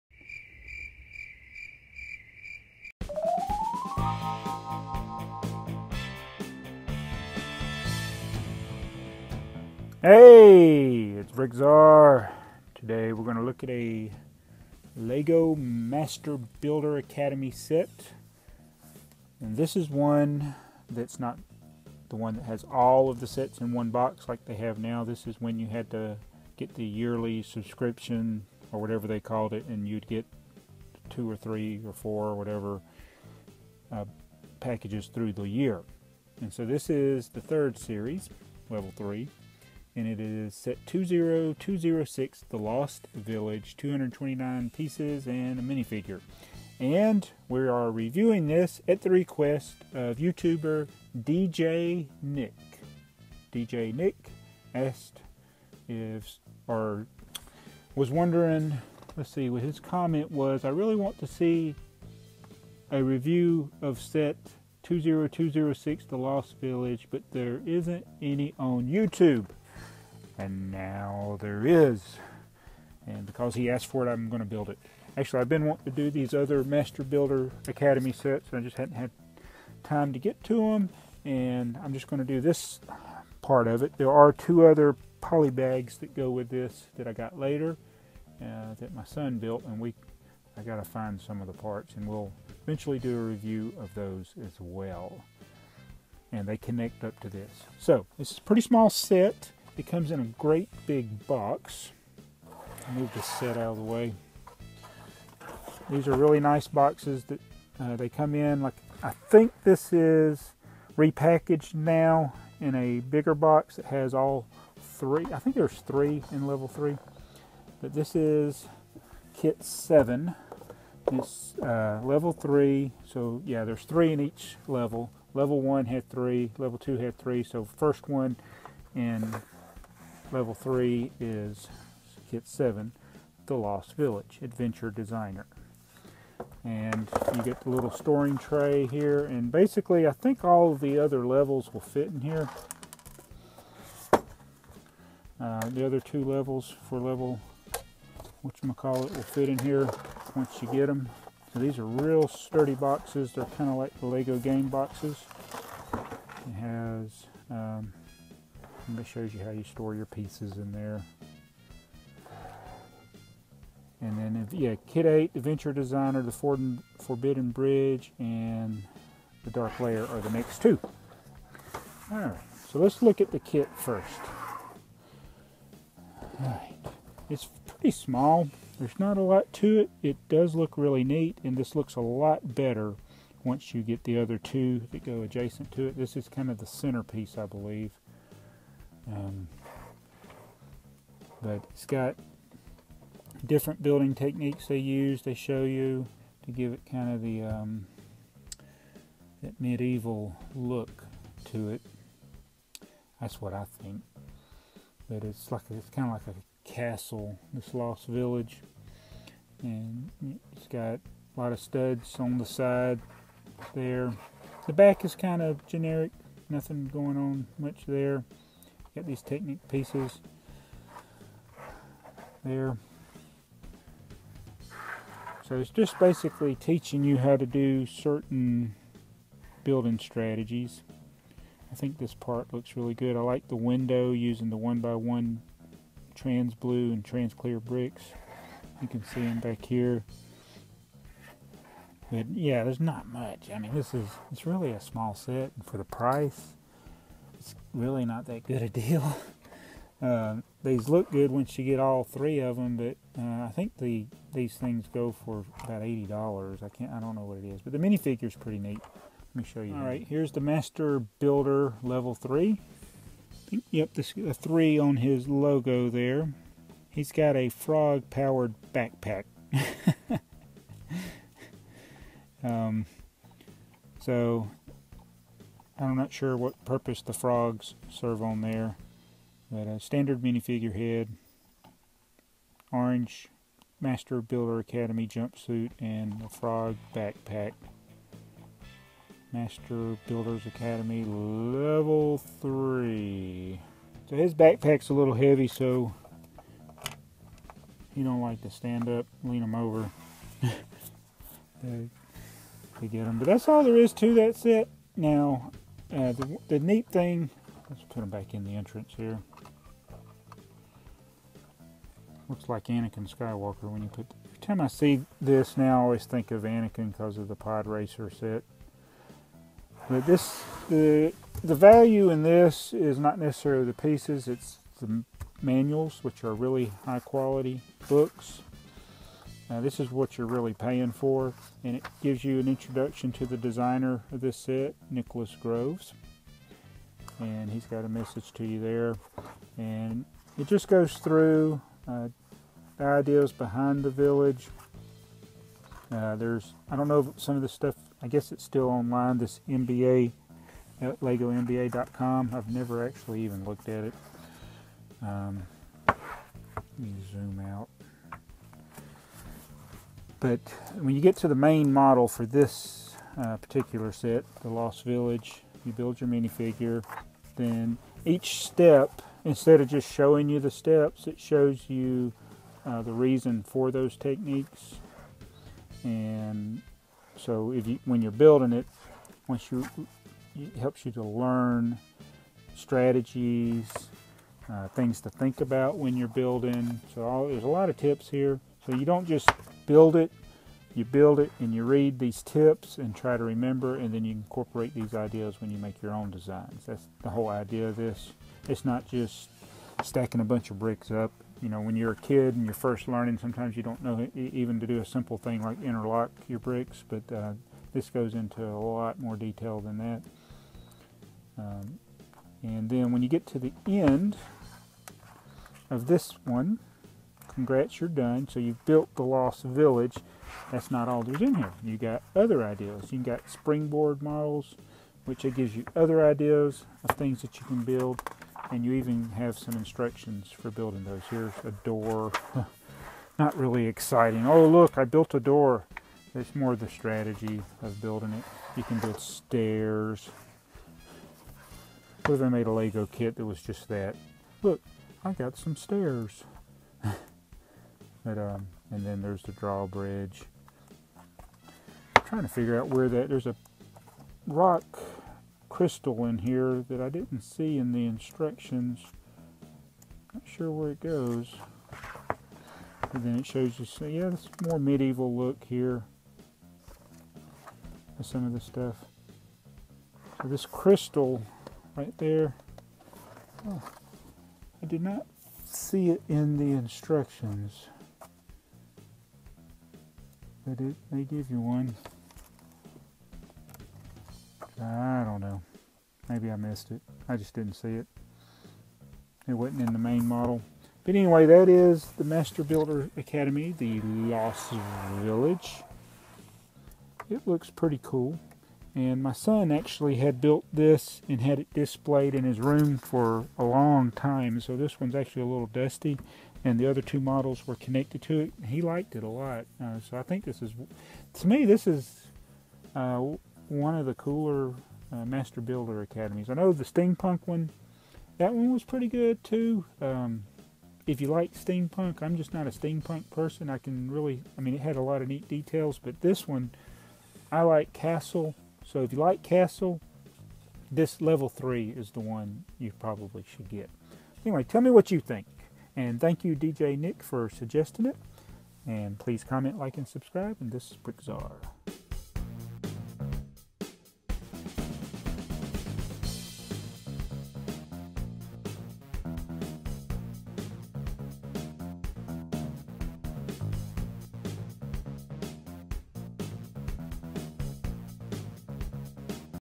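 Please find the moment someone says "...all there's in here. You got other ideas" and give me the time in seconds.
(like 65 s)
420 s.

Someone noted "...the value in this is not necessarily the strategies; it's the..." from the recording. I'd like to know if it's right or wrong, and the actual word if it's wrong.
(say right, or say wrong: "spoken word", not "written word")
wrong: "pieces", not "strategies".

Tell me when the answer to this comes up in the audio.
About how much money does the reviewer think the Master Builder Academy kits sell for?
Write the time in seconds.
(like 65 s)
255 s.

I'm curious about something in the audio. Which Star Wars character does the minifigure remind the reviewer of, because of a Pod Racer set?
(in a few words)
Anakin Skywalker.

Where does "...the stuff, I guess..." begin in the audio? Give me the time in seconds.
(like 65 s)
347 s.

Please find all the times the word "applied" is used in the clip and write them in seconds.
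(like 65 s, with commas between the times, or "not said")
not said.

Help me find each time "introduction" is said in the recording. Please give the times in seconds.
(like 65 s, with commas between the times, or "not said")
332 s.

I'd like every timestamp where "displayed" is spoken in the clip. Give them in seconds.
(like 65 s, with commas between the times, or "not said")
501 s.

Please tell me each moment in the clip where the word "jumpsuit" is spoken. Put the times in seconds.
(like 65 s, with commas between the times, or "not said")
285 s.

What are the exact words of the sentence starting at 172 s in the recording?
All right, so let's look at the kit first.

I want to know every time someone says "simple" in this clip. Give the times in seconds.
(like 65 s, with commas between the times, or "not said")
404 s.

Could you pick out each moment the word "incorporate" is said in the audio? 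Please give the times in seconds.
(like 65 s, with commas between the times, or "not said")
394 s.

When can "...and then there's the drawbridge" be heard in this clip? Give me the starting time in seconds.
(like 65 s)
448 s.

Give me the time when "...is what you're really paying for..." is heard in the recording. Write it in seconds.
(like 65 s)
329 s.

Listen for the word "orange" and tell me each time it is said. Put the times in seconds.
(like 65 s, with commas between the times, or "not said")
282 s.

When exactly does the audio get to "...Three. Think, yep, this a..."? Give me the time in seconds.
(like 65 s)
262 s.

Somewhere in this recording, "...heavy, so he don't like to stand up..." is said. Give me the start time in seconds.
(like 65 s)
295 s.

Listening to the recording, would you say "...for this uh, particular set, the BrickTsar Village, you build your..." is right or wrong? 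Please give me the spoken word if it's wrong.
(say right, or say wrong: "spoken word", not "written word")
wrong: "Lost", not "BrickTsar".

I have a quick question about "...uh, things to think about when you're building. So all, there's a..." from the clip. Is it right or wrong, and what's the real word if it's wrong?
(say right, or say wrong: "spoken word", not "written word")
right.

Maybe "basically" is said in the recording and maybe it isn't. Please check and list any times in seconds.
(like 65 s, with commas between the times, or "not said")
139 s, 225 s.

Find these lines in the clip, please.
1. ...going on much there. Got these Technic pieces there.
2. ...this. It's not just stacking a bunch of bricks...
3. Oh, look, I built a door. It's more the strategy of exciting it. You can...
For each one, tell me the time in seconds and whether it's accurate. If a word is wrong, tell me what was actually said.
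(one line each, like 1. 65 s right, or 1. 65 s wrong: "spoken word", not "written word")
1. 216 s right
2. 397 s right
3. 434 s wrong: "building", not "exciting".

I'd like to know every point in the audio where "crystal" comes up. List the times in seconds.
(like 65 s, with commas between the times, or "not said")
455 s, 470 s.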